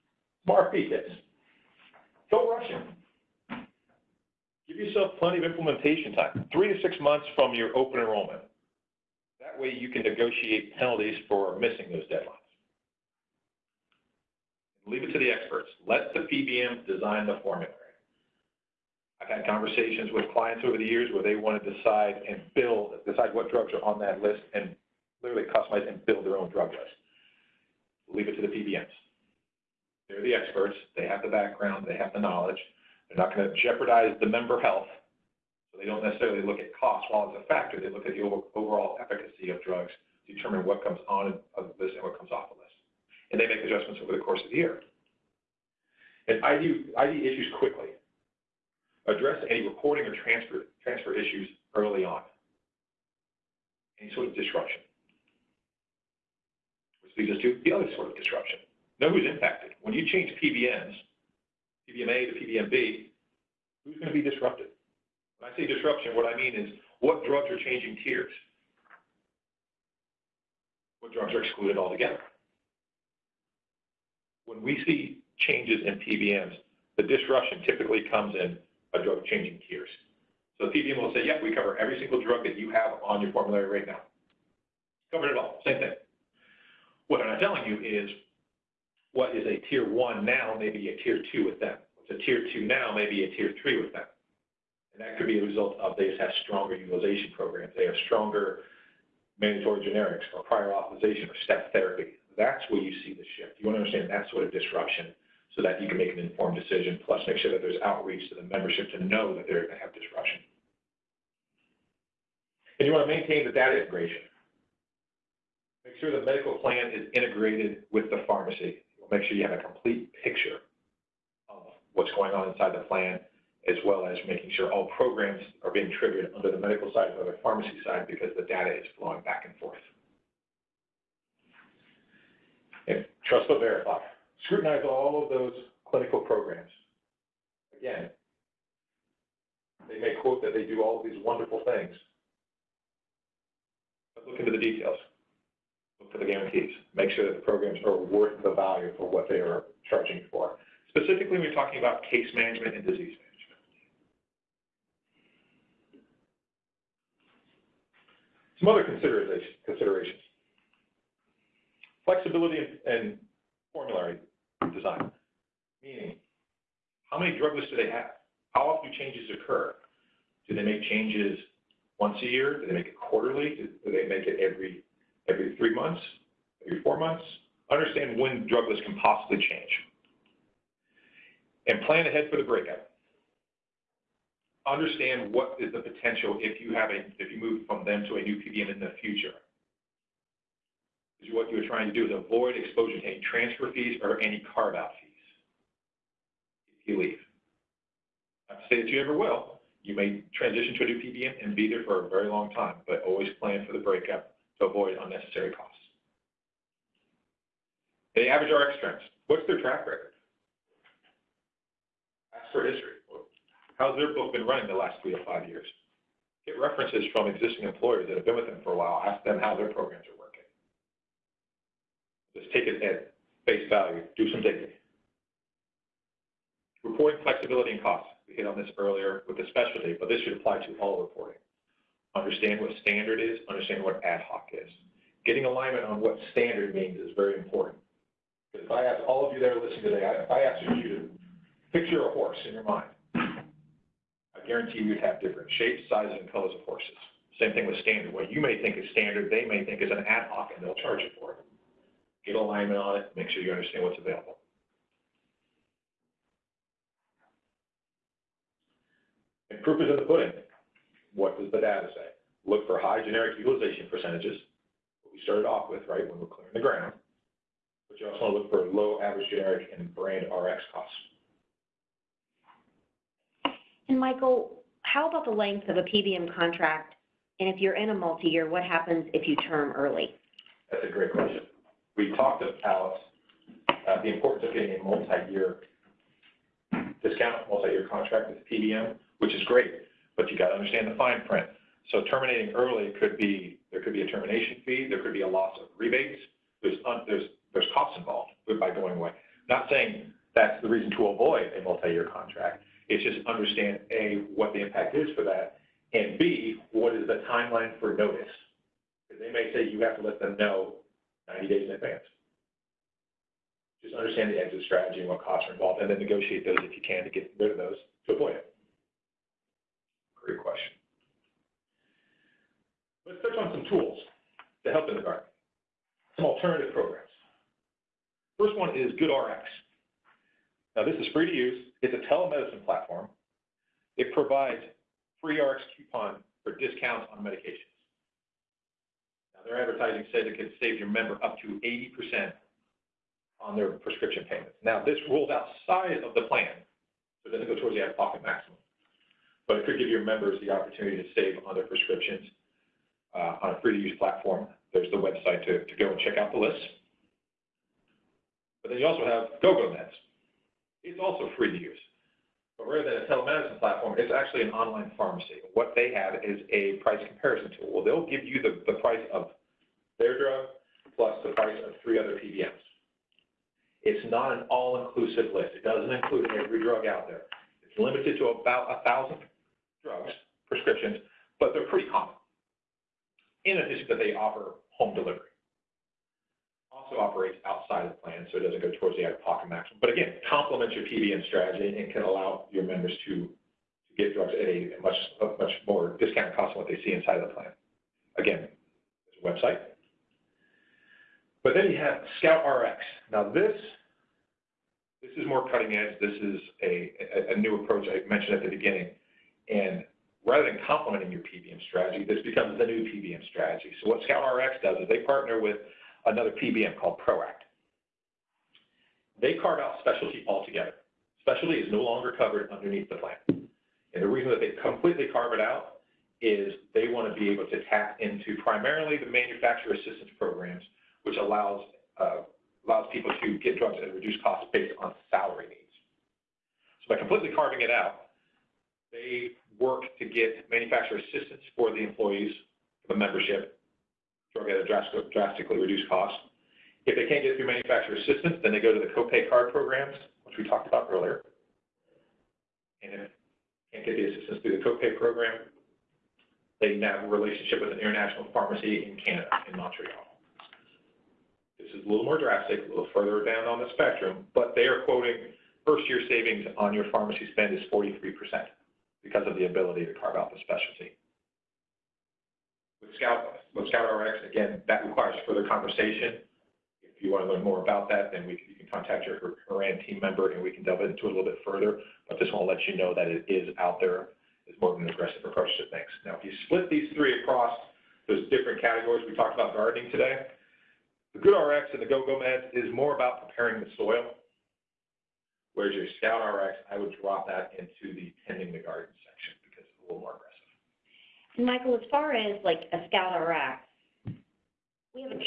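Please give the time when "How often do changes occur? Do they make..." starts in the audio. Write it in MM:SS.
02:48.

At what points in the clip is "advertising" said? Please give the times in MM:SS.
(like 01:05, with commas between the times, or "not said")
05:39.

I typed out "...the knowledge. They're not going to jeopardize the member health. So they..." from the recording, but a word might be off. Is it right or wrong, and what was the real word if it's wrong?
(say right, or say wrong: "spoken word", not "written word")
right.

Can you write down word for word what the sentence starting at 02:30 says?
Specifically, we're talking about case management and disease management.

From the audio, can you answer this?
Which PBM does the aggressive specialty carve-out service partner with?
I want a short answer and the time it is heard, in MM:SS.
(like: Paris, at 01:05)
Proact, at 06:57.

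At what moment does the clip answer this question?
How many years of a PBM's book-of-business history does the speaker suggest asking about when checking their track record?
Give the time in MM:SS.
03:35.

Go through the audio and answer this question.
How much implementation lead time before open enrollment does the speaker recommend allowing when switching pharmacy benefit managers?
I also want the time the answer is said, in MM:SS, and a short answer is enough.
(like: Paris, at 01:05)
3 to 6 months, at 00:06.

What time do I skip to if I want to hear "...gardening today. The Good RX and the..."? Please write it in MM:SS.
08:09.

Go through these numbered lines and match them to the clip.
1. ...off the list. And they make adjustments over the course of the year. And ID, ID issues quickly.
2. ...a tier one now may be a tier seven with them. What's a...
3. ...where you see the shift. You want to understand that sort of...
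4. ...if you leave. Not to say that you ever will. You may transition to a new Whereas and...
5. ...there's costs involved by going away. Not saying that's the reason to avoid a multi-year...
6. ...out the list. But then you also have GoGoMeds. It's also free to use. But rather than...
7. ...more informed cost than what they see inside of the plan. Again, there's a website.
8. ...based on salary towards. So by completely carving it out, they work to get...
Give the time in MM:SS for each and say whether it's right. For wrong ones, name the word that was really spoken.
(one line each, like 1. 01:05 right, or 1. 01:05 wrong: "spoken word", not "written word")
1. 00:42 right
2. 01:29 wrong: "two", not "seven"
3. 01:42 right
4. 03:16 wrong: "PBM", not "Whereas"
5. 04:57 right
6. 05:56 right
7. 06:35 wrong: "discounted", not "informed"
8. 07:14 wrong: "needs", not "towards".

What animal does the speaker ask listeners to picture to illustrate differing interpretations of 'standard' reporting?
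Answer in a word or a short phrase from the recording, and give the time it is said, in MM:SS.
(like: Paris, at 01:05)
a horse, at 04:02.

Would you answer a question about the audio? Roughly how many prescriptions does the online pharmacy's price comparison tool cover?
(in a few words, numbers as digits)
about 1,000.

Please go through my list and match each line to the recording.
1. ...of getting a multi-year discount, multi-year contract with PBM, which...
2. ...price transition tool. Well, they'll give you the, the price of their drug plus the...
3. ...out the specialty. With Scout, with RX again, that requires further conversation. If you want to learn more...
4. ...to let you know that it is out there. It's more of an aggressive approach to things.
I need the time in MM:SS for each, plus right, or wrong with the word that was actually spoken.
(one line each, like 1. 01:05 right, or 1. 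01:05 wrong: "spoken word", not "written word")
1. 04:44 right
2. 06:06 wrong: "comparison", not "transition"
3. 07:50 right
4. 08:02 right.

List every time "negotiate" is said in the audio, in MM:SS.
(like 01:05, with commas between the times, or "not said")
00:10, 05:15.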